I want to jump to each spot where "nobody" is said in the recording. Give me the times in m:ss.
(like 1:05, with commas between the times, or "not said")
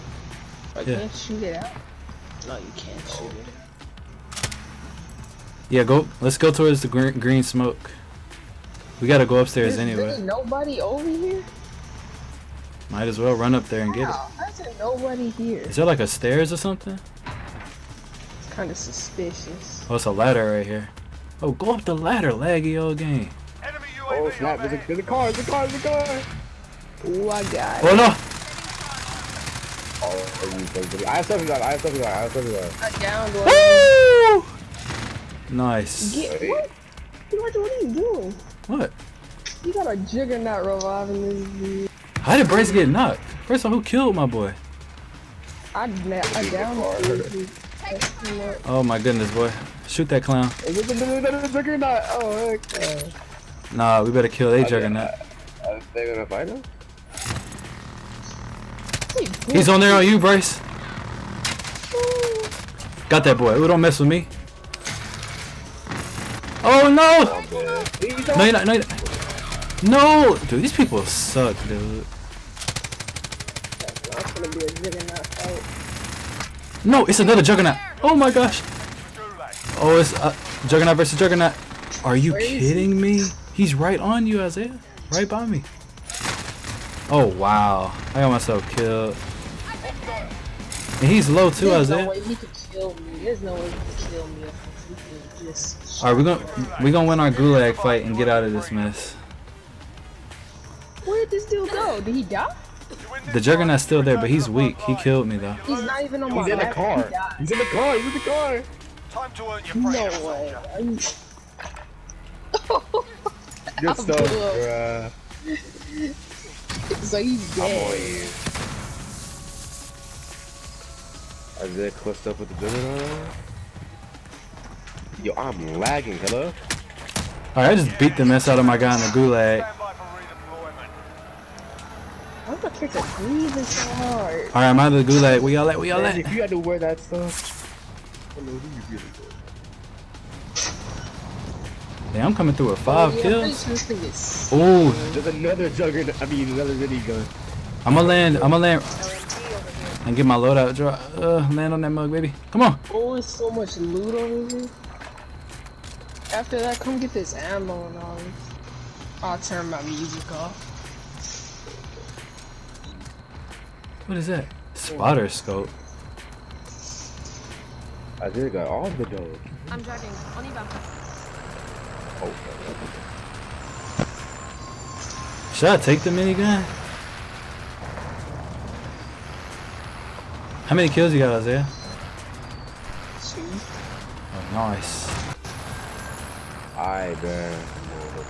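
0:10, 0:14.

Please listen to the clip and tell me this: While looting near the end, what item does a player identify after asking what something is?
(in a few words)
Spotter scope.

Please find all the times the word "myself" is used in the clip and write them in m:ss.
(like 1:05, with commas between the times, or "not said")
1:28.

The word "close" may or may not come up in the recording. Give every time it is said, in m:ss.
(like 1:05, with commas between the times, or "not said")
2:01.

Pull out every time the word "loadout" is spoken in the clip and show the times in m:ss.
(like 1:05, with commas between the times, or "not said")
2:30.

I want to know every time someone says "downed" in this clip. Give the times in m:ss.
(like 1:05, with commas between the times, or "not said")
0:32, 0:46.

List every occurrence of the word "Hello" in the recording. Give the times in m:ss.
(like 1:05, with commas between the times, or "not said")
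2:06, 2:18.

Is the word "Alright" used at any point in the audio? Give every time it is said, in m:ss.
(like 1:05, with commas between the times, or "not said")
2:07, 2:14.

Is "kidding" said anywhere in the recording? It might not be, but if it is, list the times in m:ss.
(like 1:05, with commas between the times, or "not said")
1:22.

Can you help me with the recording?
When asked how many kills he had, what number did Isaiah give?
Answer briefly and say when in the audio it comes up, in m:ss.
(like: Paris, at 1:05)
2, at 3:03.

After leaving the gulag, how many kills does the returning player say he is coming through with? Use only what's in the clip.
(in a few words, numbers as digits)
5.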